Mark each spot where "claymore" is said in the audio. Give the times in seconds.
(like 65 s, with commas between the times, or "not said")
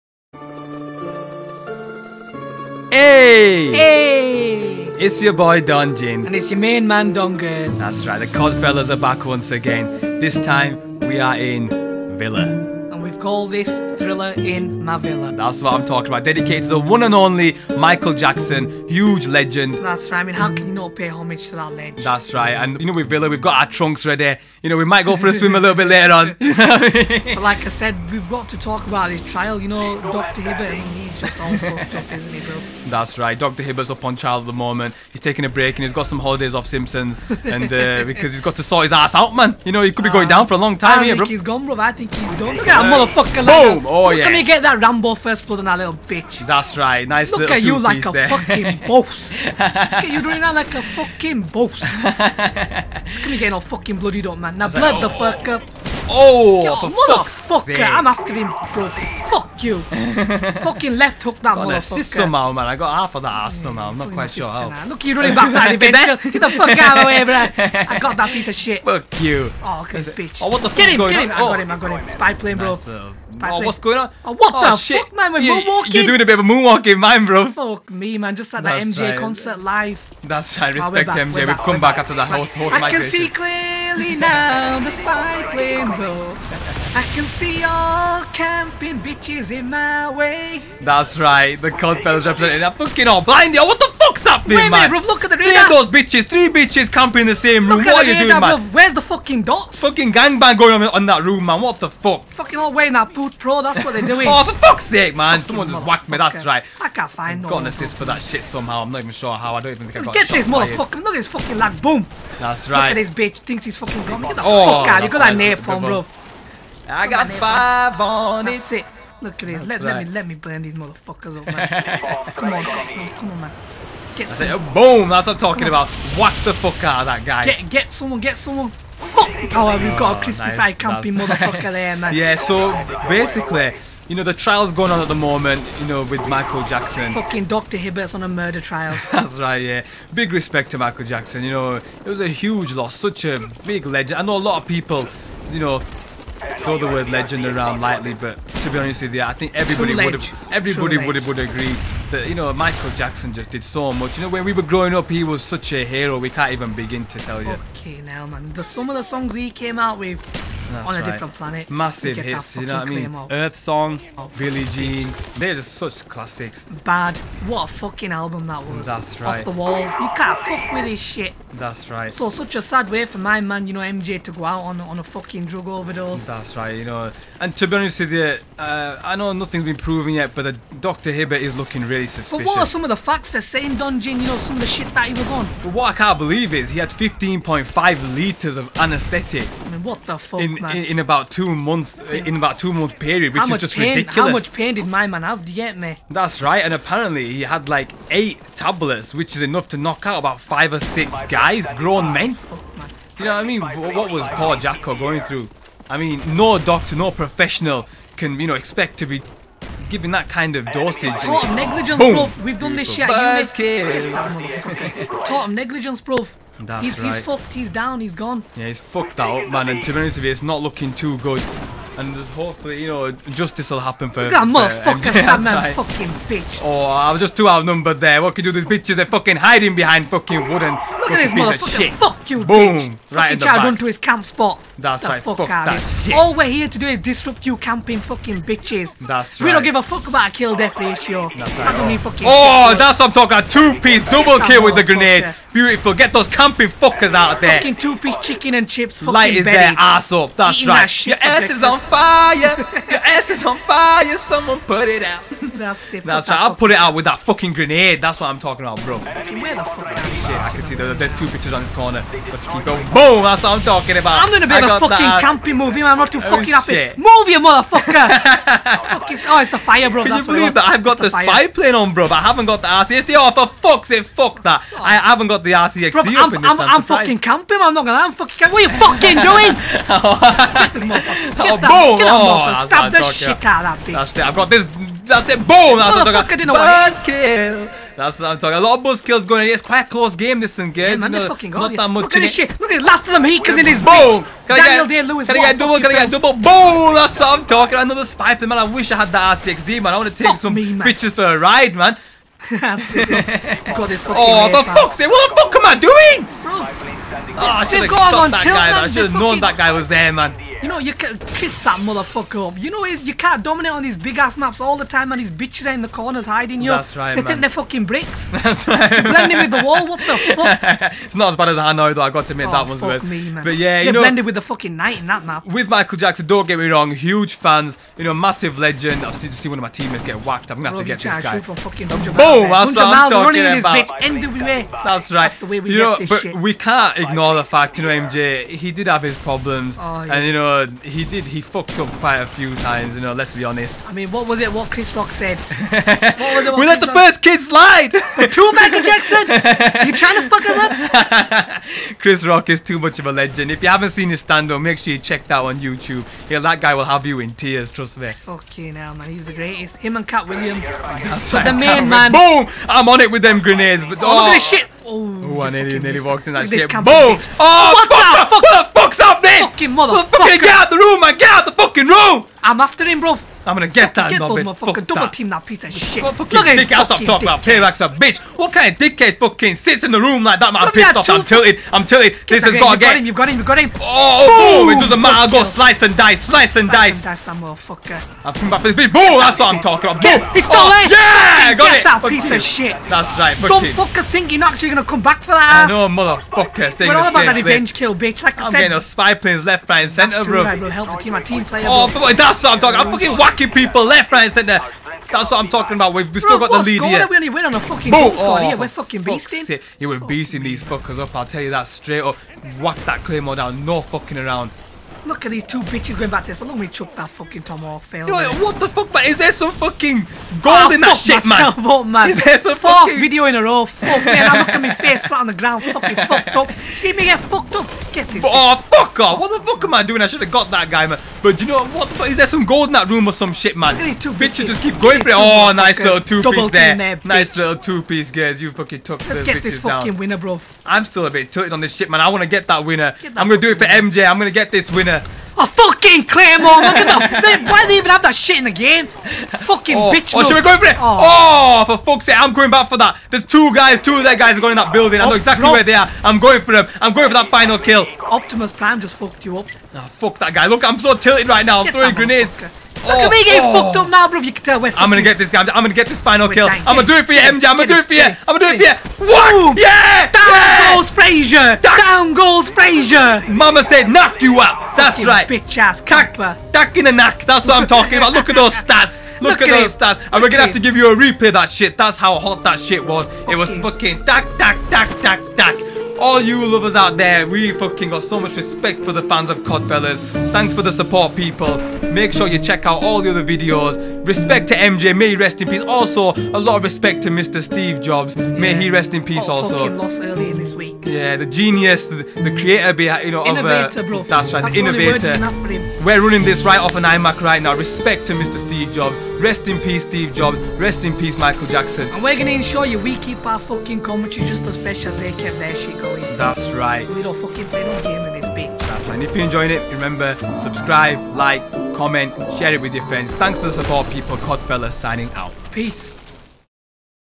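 413 s, 446 s.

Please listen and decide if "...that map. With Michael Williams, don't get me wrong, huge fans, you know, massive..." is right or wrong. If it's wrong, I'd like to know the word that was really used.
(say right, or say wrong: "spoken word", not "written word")
wrong: "Jackson", not "Williams".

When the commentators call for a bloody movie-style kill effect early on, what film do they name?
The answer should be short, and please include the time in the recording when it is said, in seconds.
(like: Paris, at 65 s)
Rambo First Blood, at 44 s.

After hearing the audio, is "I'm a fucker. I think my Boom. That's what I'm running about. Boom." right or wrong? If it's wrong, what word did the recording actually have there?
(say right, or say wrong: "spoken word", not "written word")
wrong: "talking", not "running".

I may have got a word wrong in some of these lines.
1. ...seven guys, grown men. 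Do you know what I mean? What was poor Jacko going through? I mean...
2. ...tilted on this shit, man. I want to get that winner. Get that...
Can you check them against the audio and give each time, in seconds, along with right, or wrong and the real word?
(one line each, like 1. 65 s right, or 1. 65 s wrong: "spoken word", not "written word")
1. 200 s wrong: "six", not "seven"
2. 441 s right.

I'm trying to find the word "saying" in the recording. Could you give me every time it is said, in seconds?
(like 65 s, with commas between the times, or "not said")
183 s.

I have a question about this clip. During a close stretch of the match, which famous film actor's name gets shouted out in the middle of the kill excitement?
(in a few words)
Daniel Day Lewis.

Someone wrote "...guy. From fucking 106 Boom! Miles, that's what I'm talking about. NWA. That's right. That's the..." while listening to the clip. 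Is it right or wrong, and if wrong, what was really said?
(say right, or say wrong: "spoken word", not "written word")
wrong: "100", not "106".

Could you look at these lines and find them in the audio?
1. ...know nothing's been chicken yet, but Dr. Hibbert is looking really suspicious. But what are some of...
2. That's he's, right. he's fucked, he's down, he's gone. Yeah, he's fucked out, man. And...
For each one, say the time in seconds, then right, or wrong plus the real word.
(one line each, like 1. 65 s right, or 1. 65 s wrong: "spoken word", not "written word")
1. 179 s wrong: "proven", not "chicken"
2. 216 s right.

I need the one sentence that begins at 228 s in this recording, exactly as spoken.
These bitches, they're fucking hiding behind fucking wooden.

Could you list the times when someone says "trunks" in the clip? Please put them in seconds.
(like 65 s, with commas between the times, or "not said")
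23 s.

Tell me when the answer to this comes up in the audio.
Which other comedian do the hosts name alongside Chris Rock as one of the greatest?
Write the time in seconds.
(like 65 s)
360 s.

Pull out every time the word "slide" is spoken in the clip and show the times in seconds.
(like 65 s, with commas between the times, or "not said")
347 s.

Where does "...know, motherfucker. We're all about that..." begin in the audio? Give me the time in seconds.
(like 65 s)
395 s.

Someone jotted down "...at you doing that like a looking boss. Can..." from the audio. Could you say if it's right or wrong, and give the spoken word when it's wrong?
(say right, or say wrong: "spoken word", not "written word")
wrong: "fucking", not "looking".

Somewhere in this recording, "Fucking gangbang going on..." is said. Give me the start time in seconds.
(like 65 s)
99 s.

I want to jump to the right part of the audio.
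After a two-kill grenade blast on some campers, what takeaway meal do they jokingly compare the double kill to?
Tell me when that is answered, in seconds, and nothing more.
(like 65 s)
248 s.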